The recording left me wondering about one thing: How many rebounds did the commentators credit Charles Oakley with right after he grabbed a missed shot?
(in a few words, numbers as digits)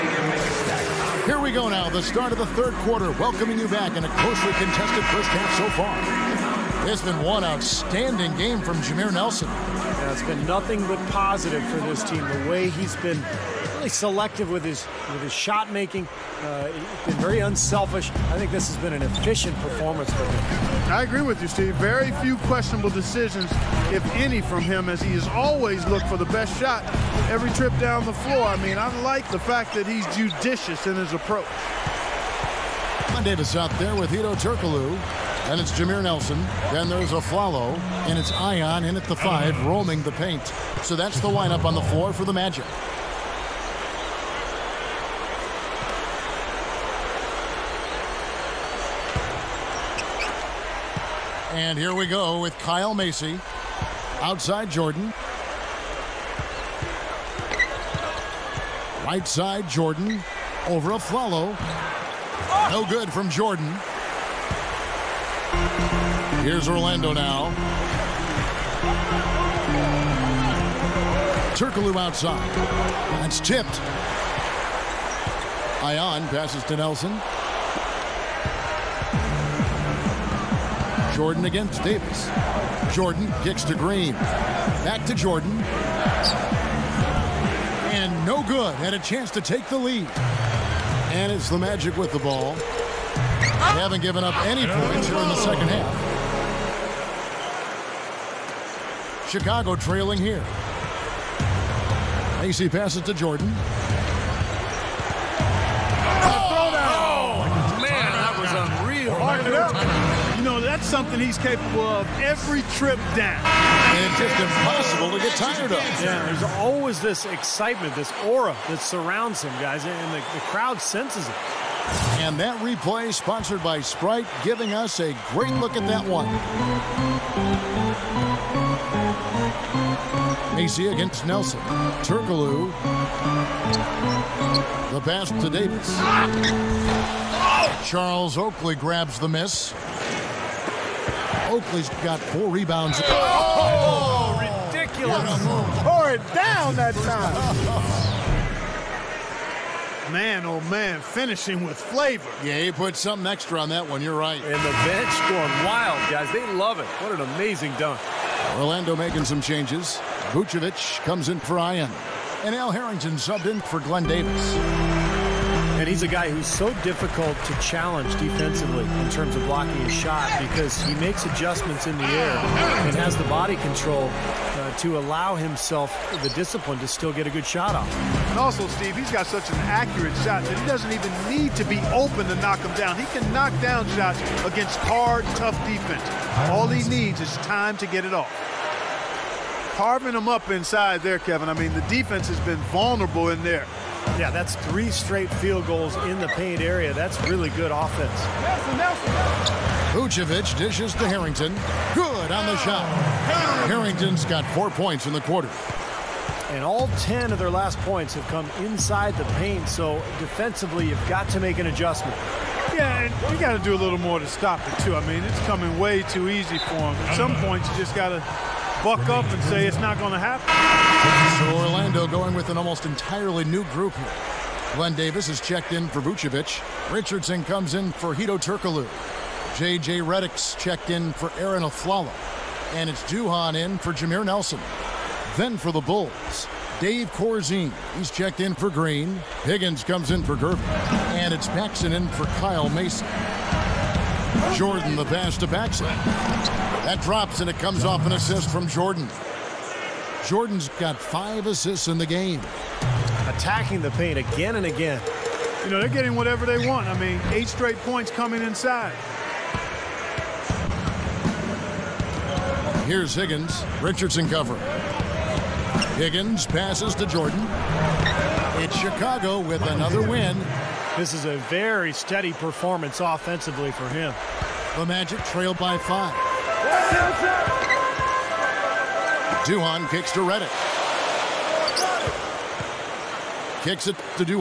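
4.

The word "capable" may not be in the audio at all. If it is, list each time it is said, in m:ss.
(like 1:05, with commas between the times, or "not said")
1:51.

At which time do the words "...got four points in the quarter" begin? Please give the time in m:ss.
3:24.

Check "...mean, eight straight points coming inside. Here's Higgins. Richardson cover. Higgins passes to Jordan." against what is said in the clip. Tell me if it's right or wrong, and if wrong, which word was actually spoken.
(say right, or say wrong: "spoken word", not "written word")
right.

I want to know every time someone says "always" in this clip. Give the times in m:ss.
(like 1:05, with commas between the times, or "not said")
0:25, 1:56.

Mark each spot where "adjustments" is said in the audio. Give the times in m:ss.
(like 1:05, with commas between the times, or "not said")
2:51, 3:31.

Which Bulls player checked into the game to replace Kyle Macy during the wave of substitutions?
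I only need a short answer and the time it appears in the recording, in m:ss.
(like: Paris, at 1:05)
Paxson, at 4:01.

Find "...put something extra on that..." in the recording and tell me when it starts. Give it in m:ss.
2:32.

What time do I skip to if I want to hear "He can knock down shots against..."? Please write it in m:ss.
3:02.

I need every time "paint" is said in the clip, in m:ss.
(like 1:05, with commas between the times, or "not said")
0:40, 3:16, 3:29, 4:13.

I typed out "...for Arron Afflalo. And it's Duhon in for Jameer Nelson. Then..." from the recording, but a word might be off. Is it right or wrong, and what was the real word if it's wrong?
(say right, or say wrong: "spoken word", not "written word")
right.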